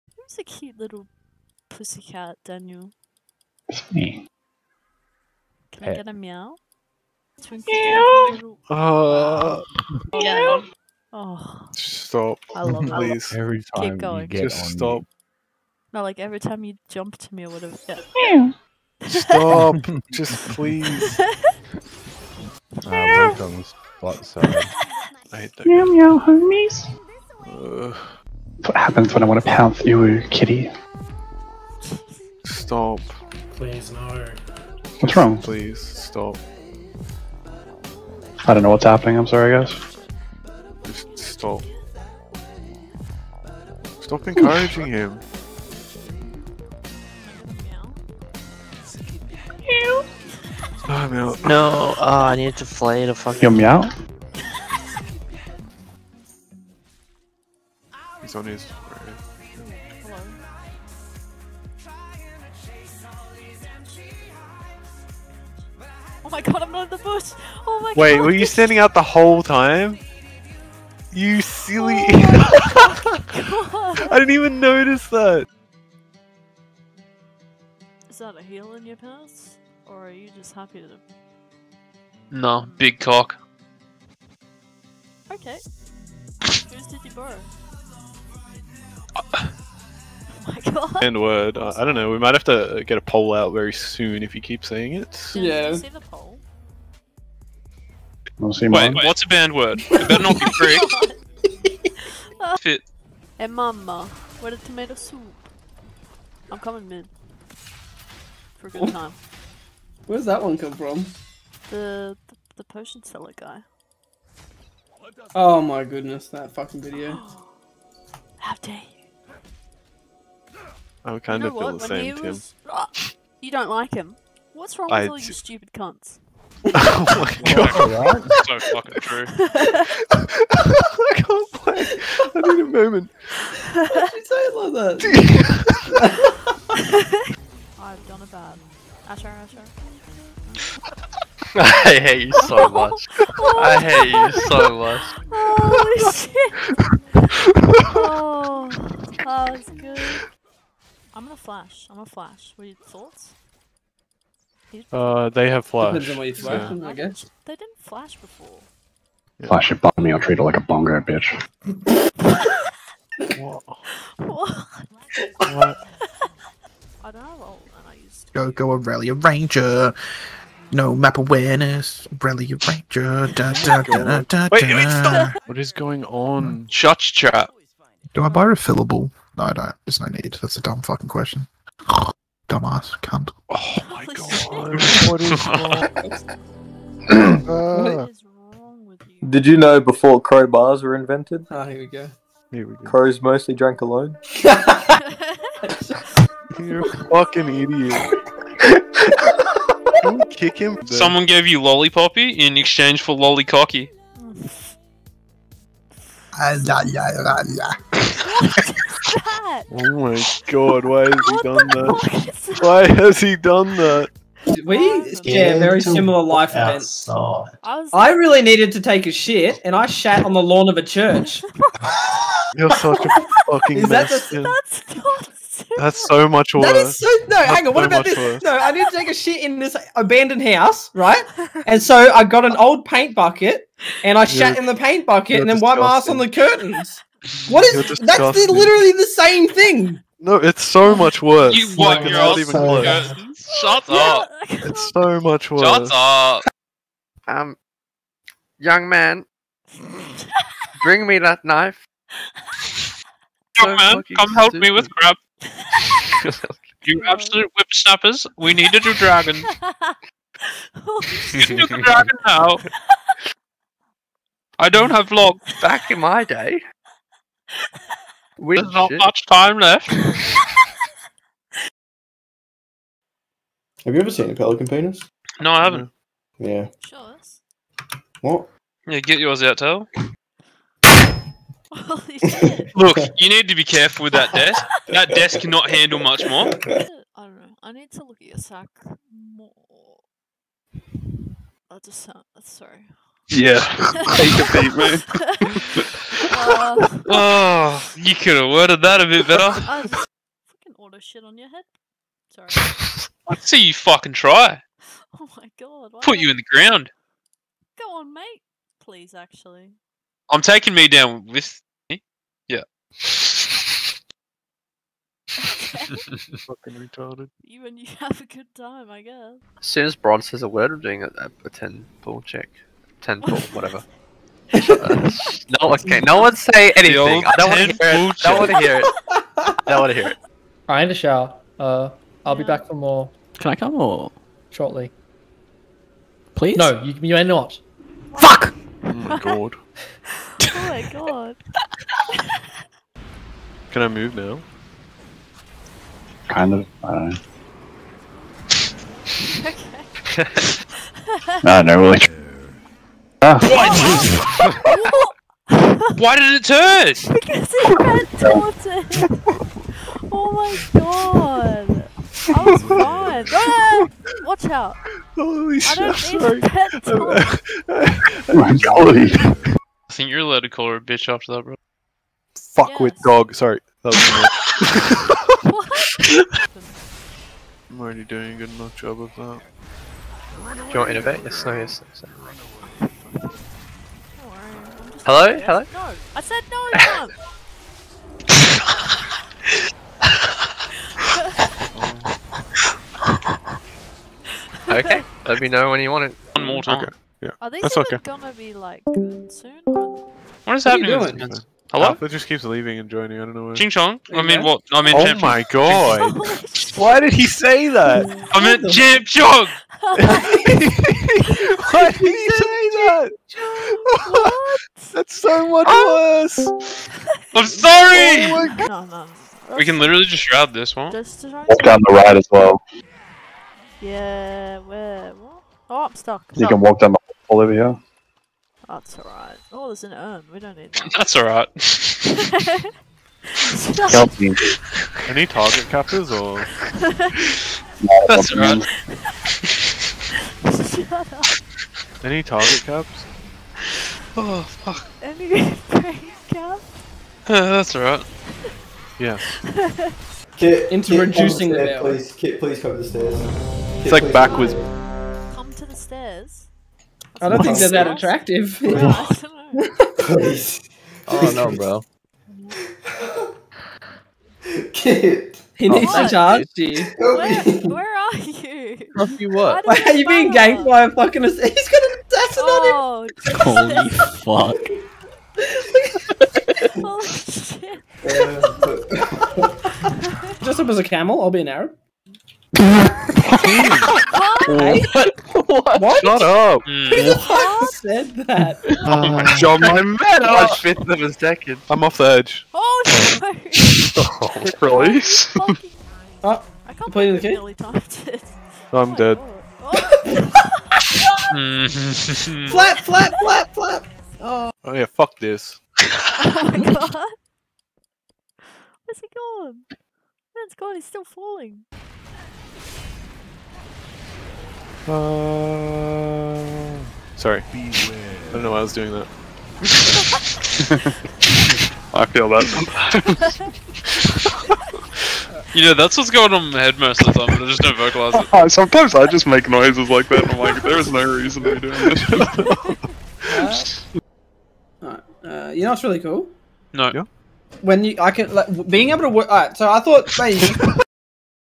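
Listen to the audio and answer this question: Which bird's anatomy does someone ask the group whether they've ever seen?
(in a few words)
Pelican.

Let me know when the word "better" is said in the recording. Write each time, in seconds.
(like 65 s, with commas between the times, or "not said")
100 s, 299 s.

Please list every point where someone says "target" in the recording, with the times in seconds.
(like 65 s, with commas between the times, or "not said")
435 s, 442 s.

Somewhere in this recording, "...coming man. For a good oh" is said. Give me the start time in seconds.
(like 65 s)
106 s.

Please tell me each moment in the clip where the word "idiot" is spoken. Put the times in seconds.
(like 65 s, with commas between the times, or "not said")
197 s.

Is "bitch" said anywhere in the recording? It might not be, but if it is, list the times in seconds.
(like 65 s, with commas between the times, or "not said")
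161 s, 370 s.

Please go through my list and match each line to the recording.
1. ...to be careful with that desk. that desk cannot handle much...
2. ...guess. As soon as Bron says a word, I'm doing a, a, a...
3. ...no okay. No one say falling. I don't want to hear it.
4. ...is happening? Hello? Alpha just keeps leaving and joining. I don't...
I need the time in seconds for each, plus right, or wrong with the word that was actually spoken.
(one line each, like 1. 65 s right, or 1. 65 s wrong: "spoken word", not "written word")
1. 283 s right
2. 319 s right
3. 324 s wrong: "anything", not "falling"
4. 400 s right.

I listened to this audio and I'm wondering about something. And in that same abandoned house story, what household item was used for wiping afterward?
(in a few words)
The curtains.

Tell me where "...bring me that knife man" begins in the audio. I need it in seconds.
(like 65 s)
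250 s.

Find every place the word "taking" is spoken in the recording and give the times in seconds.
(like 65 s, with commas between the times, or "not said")
310 s.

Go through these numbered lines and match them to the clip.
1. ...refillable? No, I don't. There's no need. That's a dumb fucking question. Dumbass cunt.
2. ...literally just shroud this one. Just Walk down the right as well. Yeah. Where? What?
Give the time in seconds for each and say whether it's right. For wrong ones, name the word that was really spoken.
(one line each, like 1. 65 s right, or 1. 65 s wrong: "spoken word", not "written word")
1. 178 s right
2. 419 s right.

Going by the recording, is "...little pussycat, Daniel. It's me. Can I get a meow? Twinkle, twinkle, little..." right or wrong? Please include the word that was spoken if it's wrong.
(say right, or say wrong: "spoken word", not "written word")
right.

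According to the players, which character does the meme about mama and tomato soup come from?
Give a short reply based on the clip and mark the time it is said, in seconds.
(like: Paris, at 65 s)
Potion seller guy, at 112 s.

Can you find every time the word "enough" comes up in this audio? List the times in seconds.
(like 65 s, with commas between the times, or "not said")
378 s.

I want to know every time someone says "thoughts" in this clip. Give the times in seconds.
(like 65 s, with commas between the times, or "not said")
152 s, 539 s.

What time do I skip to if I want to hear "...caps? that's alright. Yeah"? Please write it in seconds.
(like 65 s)
446 s.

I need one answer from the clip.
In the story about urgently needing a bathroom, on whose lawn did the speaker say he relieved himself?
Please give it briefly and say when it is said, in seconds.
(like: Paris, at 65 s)
A church, at 220 s.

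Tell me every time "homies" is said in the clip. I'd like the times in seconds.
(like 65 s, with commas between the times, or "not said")
26 s.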